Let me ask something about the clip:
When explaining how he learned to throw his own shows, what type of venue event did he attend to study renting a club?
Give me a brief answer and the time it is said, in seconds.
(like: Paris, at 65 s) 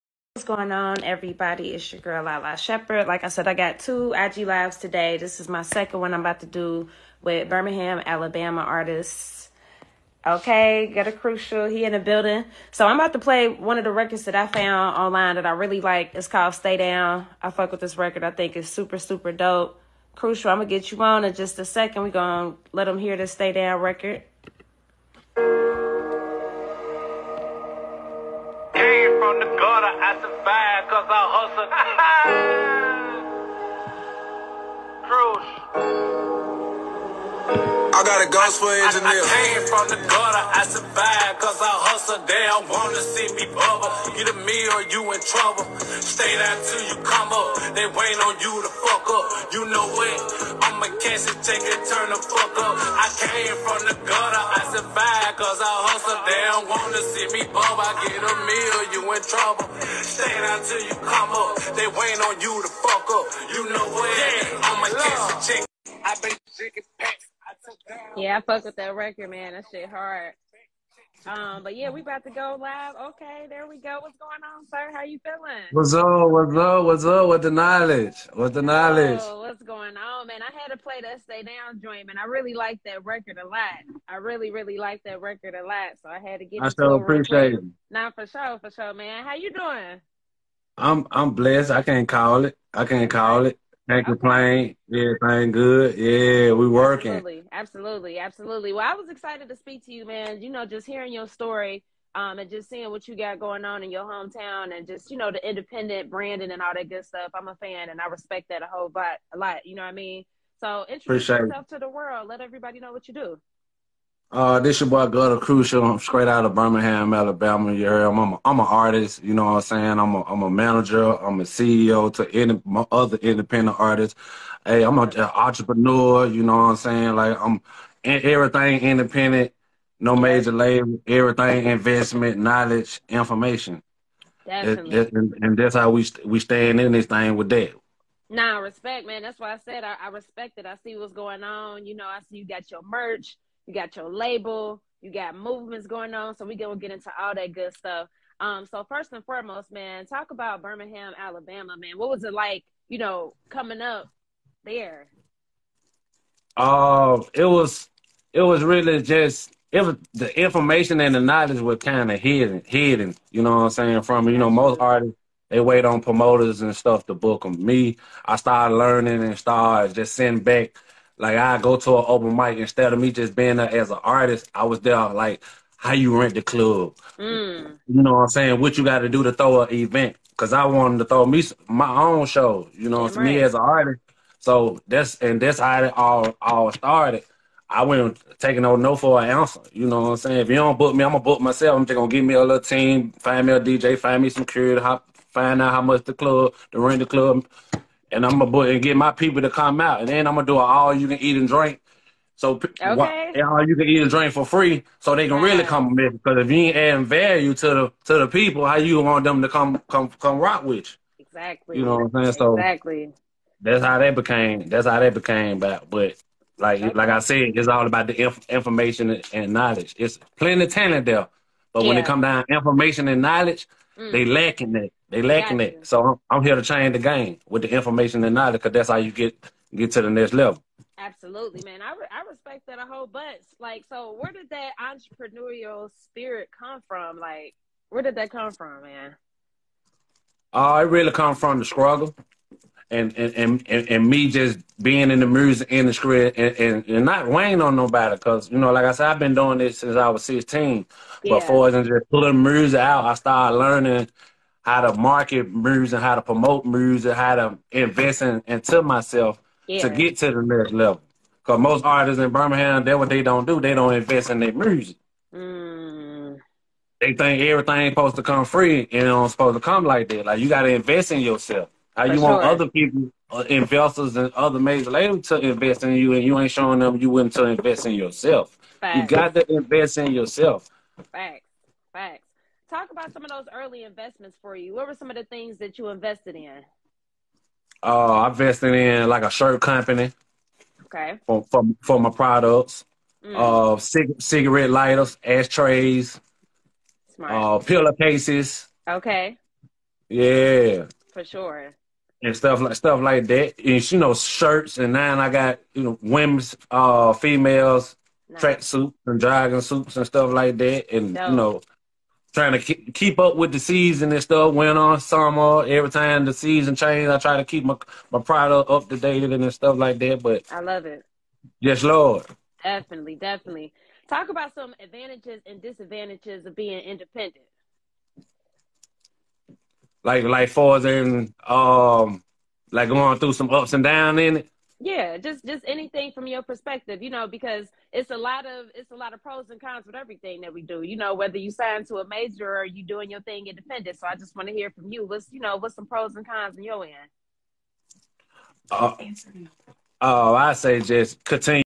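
an open mic, at 171 s.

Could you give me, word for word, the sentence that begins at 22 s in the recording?
are gonna let him hear the Stay Down record.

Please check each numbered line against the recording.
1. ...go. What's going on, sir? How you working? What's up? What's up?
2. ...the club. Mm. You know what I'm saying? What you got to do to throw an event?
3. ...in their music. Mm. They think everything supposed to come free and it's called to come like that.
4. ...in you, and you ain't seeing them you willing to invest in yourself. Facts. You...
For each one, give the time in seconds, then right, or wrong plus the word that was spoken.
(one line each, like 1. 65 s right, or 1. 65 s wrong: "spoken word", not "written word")
1. 73 s wrong: "feeling", not "working"
2. 176 s right
3. 264 s wrong: "supposed", not "called"
4. 275 s wrong: "showing", not "seeing".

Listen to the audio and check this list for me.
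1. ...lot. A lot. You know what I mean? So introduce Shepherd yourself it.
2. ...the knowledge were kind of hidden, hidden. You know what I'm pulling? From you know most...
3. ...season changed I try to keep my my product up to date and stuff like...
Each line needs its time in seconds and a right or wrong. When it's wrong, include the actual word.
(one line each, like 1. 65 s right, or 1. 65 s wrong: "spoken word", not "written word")
1. 108 s wrong: "Appreciate", not "Shepherd"
2. 161 s wrong: "saying", not "pulling"
3. 316 s right.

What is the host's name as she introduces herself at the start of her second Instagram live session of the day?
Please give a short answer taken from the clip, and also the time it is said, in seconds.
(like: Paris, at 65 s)
Lala Shepherd, at 2 s.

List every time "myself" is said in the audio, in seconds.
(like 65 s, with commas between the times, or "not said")
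191 s, 258 s.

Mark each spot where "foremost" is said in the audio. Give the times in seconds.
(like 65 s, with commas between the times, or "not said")
149 s.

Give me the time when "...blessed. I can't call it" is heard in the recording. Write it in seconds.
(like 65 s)
91 s.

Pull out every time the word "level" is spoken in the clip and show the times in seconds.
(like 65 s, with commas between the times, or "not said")
230 s, 260 s.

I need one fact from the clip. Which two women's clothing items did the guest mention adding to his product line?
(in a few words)
track suits and jogging suits.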